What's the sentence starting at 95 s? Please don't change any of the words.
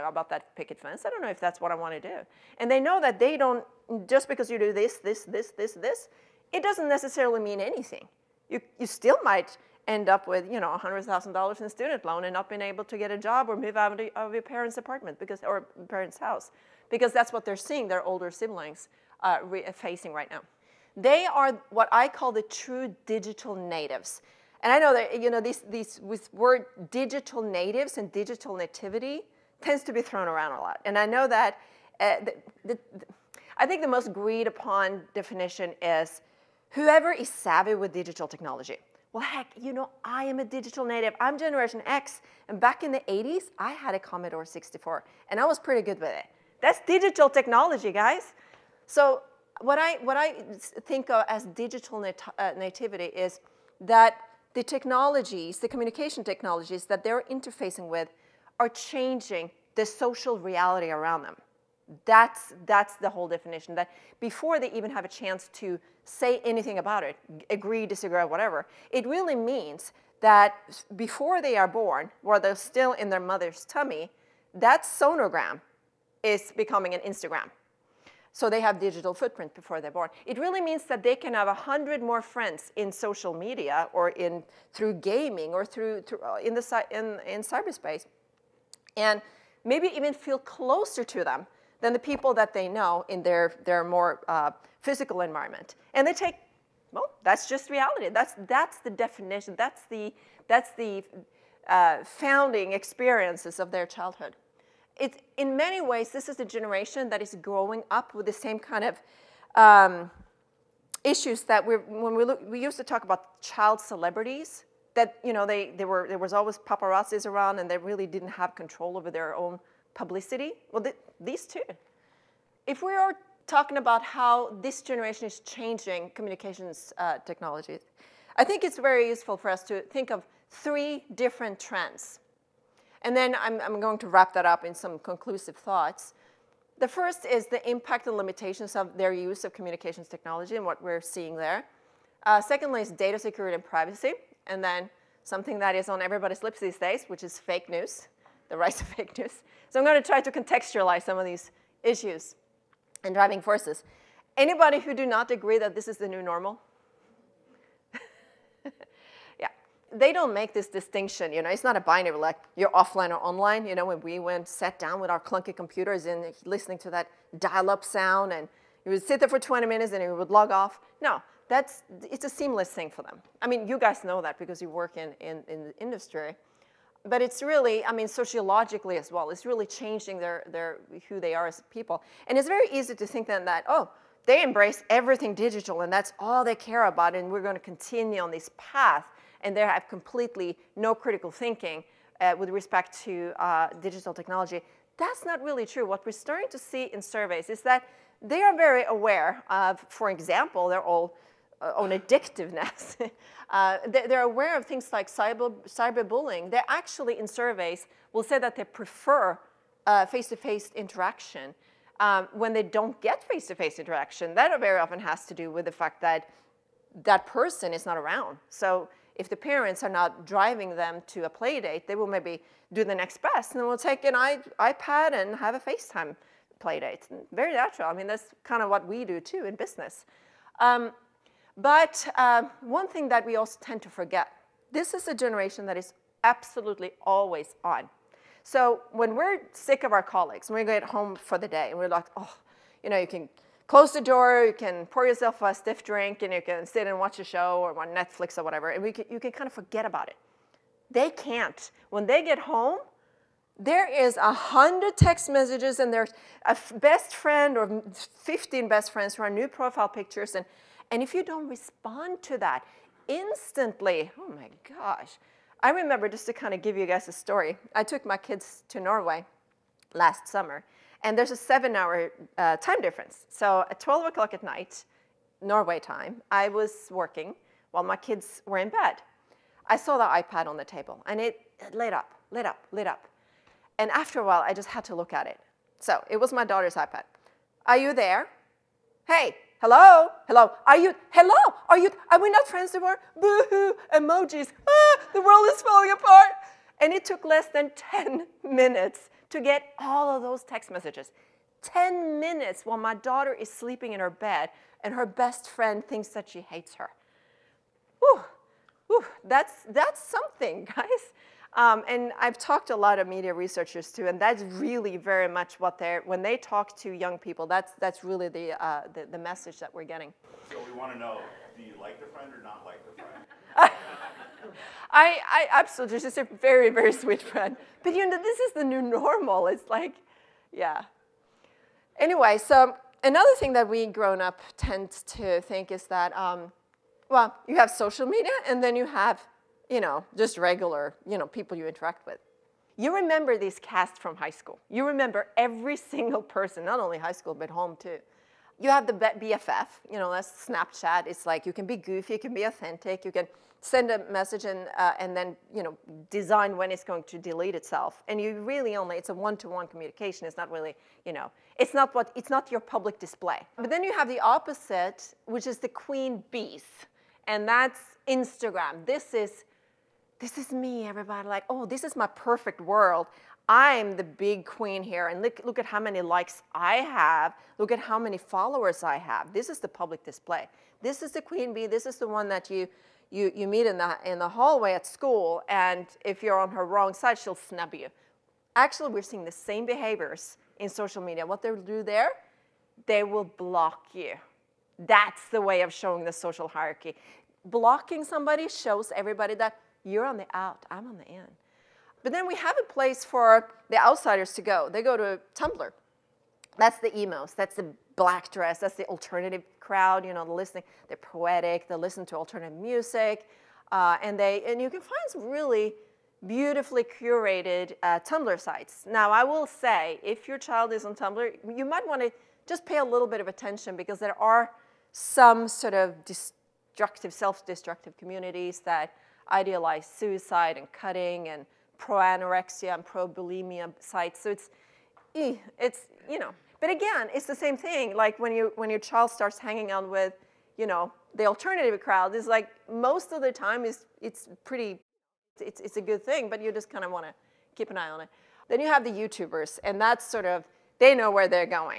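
And they take, well, that's just reality.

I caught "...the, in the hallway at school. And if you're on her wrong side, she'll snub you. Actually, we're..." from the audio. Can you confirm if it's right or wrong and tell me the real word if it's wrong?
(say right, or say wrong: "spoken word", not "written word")
right.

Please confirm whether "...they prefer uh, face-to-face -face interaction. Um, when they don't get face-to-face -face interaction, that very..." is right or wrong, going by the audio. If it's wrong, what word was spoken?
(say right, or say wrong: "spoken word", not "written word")
right.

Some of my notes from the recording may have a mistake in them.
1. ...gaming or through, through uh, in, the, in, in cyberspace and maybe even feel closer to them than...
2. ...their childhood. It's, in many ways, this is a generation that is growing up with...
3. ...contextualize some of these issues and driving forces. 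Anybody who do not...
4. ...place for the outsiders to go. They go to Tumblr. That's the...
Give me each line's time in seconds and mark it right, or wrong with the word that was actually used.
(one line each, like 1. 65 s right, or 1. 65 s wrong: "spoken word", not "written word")
1. 84 s right
2. 103 s right
3. 150 s right
4. 402 s right.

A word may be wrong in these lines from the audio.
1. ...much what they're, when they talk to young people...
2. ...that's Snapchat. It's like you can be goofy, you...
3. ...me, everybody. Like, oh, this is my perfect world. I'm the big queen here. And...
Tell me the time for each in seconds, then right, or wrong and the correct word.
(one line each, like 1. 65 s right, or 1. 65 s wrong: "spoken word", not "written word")
1. 315 s right
2. 350 s right
3. 370 s right.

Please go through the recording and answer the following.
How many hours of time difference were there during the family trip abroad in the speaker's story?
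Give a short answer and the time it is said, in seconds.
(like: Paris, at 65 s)
7, at 271 s.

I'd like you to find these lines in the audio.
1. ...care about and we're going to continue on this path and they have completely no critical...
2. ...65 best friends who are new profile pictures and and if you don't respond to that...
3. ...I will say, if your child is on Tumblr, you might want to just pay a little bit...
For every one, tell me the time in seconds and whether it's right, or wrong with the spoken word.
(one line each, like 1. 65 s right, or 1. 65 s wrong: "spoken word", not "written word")
1. 186 s right
2. 257 s wrong: "15", not "65"
3. 419 s right.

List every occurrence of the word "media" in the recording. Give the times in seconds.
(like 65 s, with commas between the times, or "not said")
83 s, 313 s, 338 s, 391 s.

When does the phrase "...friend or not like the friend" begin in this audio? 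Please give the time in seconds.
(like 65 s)
322 s.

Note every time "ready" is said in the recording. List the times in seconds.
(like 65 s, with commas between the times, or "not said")
not said.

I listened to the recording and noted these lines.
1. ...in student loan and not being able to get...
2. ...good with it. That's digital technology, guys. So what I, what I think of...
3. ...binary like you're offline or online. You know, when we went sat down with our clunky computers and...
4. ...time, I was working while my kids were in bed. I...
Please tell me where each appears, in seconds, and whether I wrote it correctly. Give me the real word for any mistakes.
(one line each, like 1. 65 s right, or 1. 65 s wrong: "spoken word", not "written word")
1. 11 s right
2. 45 s right
3. 161 s right
4. 275 s right.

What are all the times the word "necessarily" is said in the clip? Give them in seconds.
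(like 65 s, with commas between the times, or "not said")
6 s.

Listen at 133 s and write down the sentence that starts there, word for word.
And then I'm, I'm going to wrap that up in some conclusive thoughts.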